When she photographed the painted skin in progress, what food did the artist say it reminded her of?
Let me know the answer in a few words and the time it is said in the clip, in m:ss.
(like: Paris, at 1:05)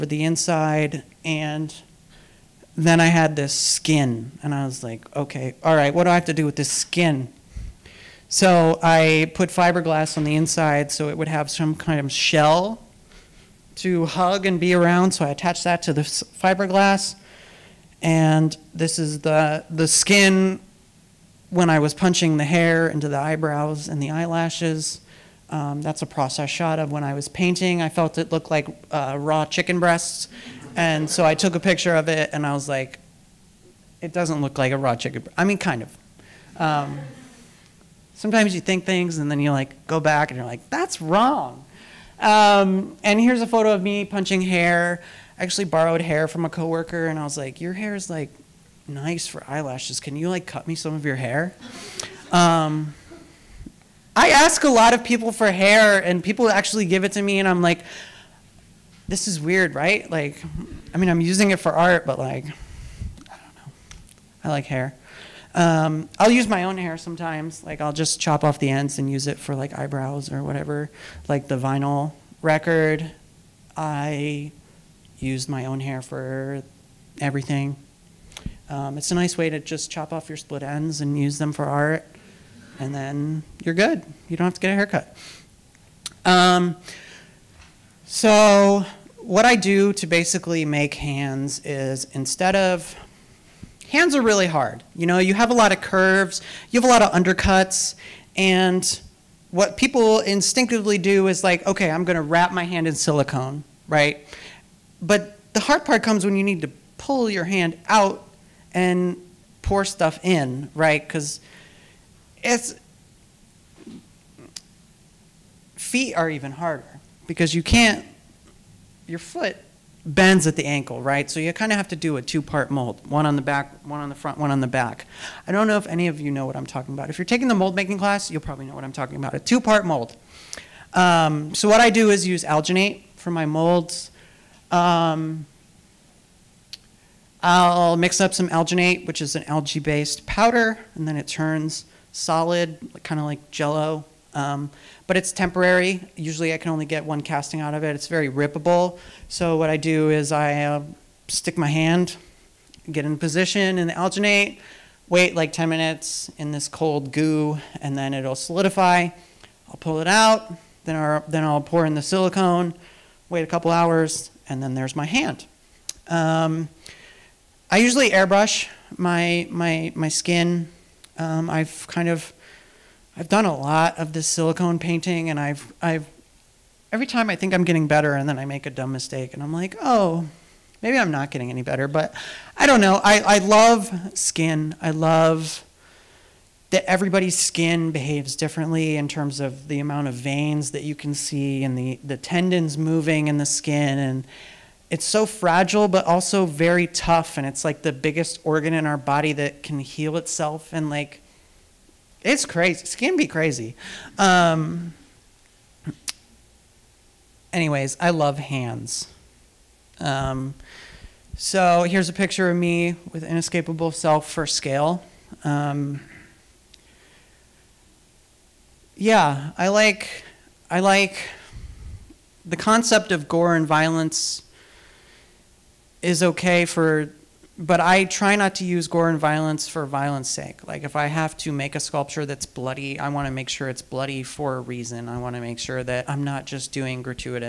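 Raw chicken breasts, at 0:29.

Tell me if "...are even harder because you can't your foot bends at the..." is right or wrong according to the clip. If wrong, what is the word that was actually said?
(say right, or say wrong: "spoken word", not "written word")
right.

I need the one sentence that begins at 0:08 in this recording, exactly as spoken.
So I put fiberglass on the inside so it would have some kind of shell to hug and be around.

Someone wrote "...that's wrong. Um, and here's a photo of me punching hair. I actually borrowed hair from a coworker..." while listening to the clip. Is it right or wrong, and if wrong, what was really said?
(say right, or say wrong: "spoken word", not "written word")
right.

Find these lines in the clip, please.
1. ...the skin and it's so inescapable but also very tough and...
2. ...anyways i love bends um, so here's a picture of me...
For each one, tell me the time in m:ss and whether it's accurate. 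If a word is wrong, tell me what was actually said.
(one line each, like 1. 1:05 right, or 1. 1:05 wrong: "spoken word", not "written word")
1. 3:13 wrong: "fragile", not "inescapable"
2. 3:27 wrong: "hands", not "bends".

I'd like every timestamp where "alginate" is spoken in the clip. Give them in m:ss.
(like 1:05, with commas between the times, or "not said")
2:12, 2:18, 2:33.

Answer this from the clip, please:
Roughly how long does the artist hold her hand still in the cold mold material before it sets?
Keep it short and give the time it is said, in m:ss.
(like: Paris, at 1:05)
10 minutes, at 2:35.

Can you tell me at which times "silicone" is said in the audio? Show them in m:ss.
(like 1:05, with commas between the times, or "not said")
1:42, 2:42, 2:54.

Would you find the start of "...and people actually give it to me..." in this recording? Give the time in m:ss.
0:56.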